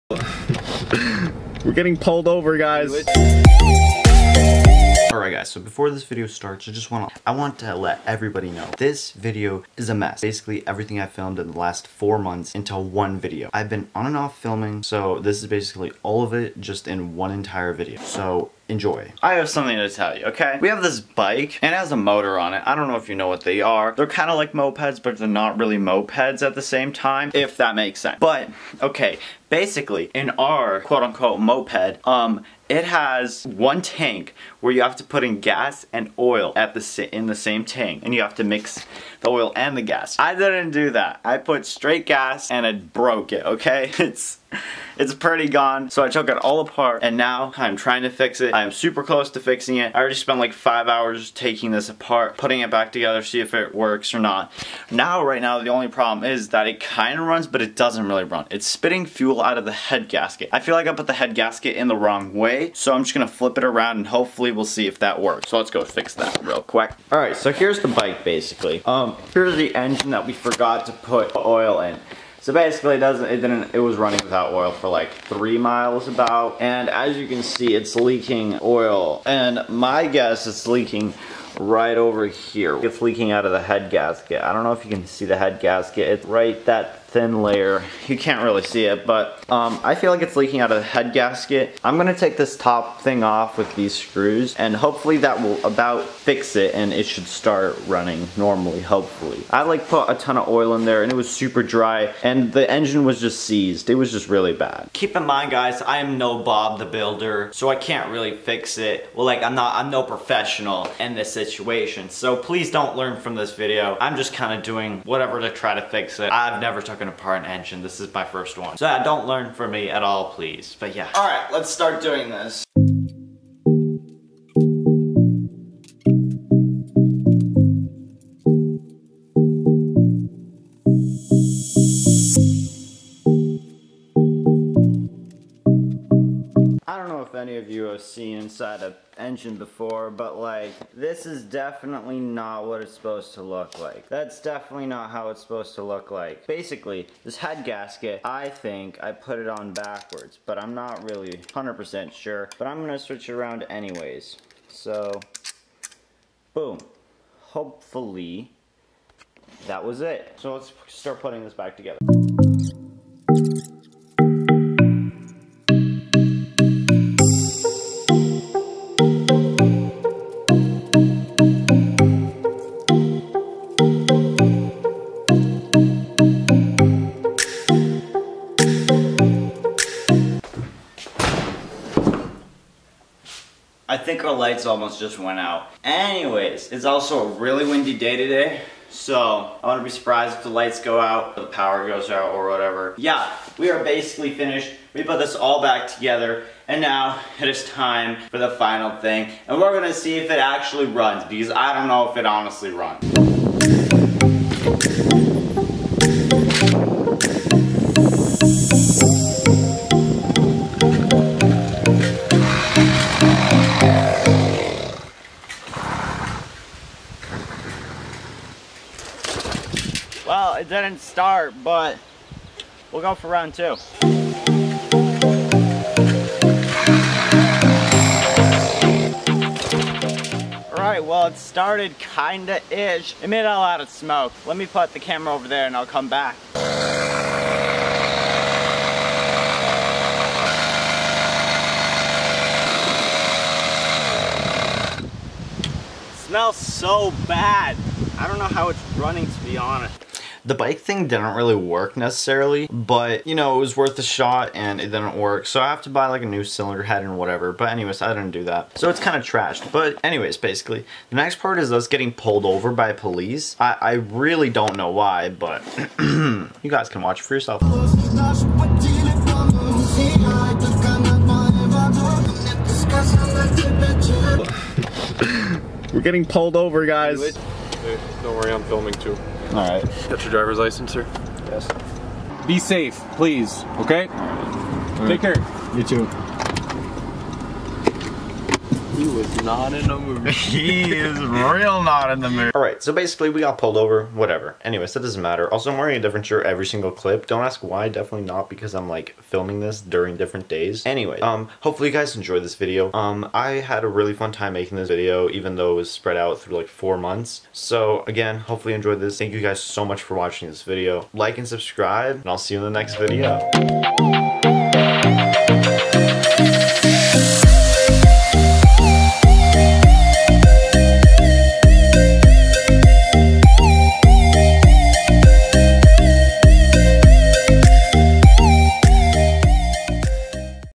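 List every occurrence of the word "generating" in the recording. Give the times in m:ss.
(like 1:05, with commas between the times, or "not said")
not said.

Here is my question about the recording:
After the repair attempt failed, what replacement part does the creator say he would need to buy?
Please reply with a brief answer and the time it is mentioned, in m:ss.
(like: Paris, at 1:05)
cylinder head, at 4:16.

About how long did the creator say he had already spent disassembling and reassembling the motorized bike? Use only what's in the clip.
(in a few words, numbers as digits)
5 hours.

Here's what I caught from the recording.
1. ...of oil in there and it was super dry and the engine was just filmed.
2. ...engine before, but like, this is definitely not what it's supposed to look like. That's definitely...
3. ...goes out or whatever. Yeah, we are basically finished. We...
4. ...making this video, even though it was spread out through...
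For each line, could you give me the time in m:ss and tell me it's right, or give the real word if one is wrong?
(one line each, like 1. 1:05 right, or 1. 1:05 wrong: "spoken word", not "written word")
1. 1:40 wrong: "seized", not "filmed"
2. 2:19 right
3. 3:11 right
4. 5:04 right.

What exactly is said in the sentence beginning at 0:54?
Now, right now, the only problem is that it kind of runs, but it doesn't really run.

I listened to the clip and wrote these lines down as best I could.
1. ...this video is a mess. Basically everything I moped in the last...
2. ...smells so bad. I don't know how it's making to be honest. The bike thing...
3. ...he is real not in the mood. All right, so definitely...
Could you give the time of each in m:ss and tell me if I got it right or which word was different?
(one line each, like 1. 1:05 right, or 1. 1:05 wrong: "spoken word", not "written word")
1. 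0:08 wrong: "filmed", not "moped"
2. 4:06 wrong: "running", not "making"
3. 4:50 wrong: "basically", not "definitely".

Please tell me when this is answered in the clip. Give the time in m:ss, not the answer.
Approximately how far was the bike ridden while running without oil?
1:15.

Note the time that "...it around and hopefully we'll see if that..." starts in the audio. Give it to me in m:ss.
1:03.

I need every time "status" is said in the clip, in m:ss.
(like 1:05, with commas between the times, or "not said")
not said.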